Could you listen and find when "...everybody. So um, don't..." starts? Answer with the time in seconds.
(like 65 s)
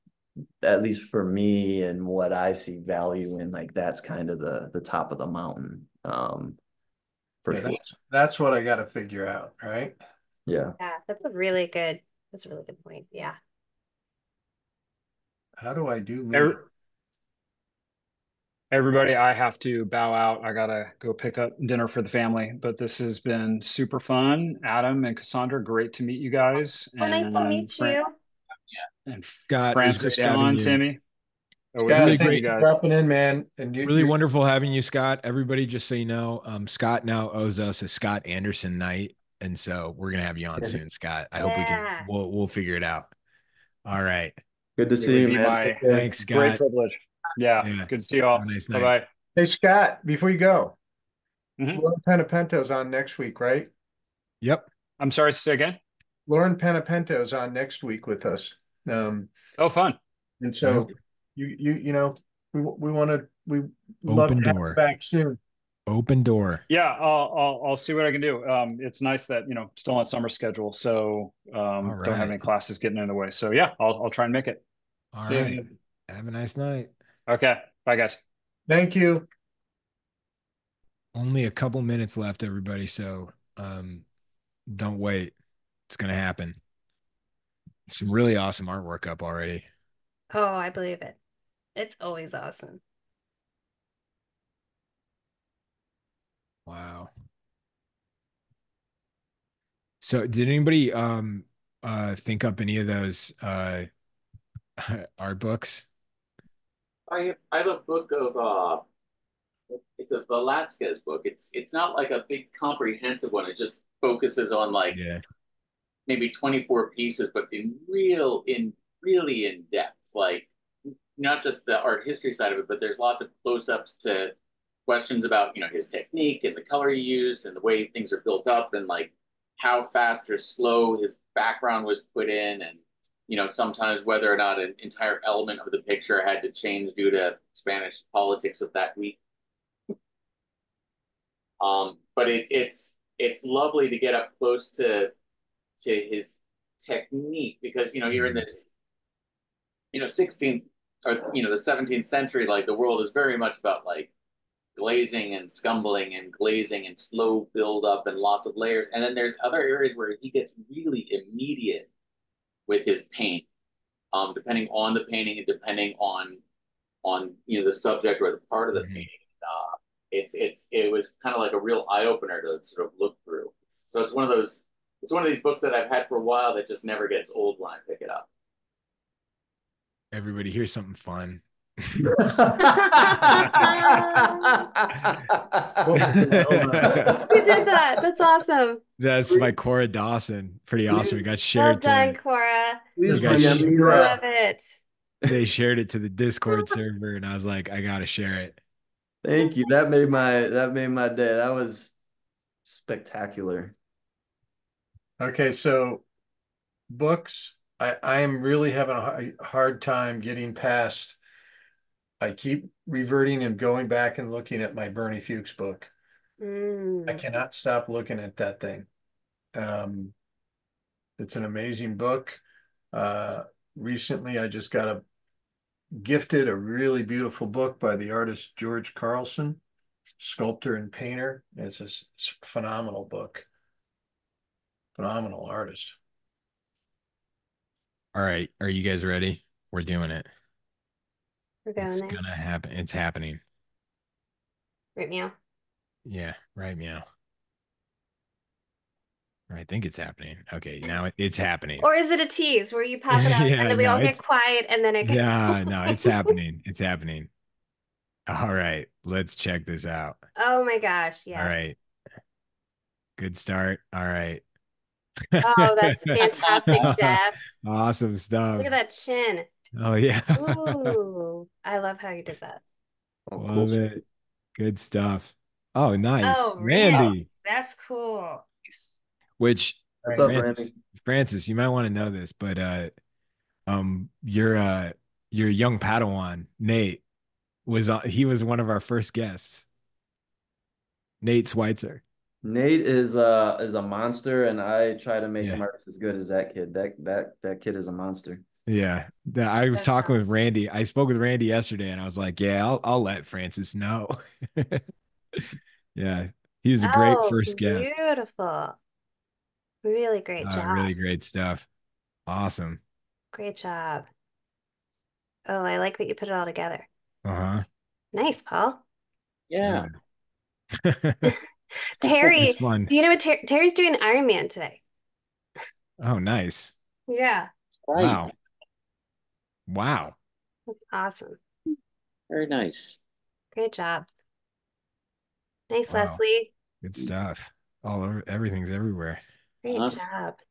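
82 s.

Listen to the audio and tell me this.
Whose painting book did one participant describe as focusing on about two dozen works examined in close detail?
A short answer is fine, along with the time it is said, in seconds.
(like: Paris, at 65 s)
Velasquez, at 110 s.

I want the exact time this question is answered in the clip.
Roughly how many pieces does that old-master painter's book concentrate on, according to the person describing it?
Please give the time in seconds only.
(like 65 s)
116 s.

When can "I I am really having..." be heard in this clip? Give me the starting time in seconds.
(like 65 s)
207 s.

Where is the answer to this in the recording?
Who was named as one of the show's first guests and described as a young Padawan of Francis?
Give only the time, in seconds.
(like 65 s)
291 s.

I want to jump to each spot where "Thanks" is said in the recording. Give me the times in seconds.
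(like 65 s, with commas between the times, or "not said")
45 s, 78 s, 199 s, 335 s.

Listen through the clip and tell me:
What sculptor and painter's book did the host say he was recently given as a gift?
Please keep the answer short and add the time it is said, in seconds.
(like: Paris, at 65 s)
George Carlson, at 228 s.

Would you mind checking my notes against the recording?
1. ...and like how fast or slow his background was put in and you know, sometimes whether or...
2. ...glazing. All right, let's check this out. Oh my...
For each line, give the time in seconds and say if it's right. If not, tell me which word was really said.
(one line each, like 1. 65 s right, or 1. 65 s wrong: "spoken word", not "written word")
1. 128 s right
2. 256 s wrong: "happening", not "glazing".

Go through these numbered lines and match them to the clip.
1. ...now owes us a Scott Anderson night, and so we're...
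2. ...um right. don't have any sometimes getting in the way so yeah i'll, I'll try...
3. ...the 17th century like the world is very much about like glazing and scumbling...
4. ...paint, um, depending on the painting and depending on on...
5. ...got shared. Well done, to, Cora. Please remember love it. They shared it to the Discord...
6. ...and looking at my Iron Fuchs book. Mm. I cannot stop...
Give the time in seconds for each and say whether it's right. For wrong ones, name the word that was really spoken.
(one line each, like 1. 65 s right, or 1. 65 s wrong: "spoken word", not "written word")
1. 37 s right
2. 71 s wrong: "classes", not "sometimes"
3. 151 s right
4. 163 s right
5. 191 s right
6. 214 s wrong: "Bernie", not "Iron".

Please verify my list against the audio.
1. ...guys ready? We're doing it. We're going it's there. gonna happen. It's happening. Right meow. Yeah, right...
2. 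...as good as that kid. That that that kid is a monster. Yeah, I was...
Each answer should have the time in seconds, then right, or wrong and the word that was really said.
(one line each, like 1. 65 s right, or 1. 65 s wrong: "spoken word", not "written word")
1. 238 s right
2. 295 s right.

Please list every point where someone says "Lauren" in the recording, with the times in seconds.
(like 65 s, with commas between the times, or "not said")
51 s, 56 s.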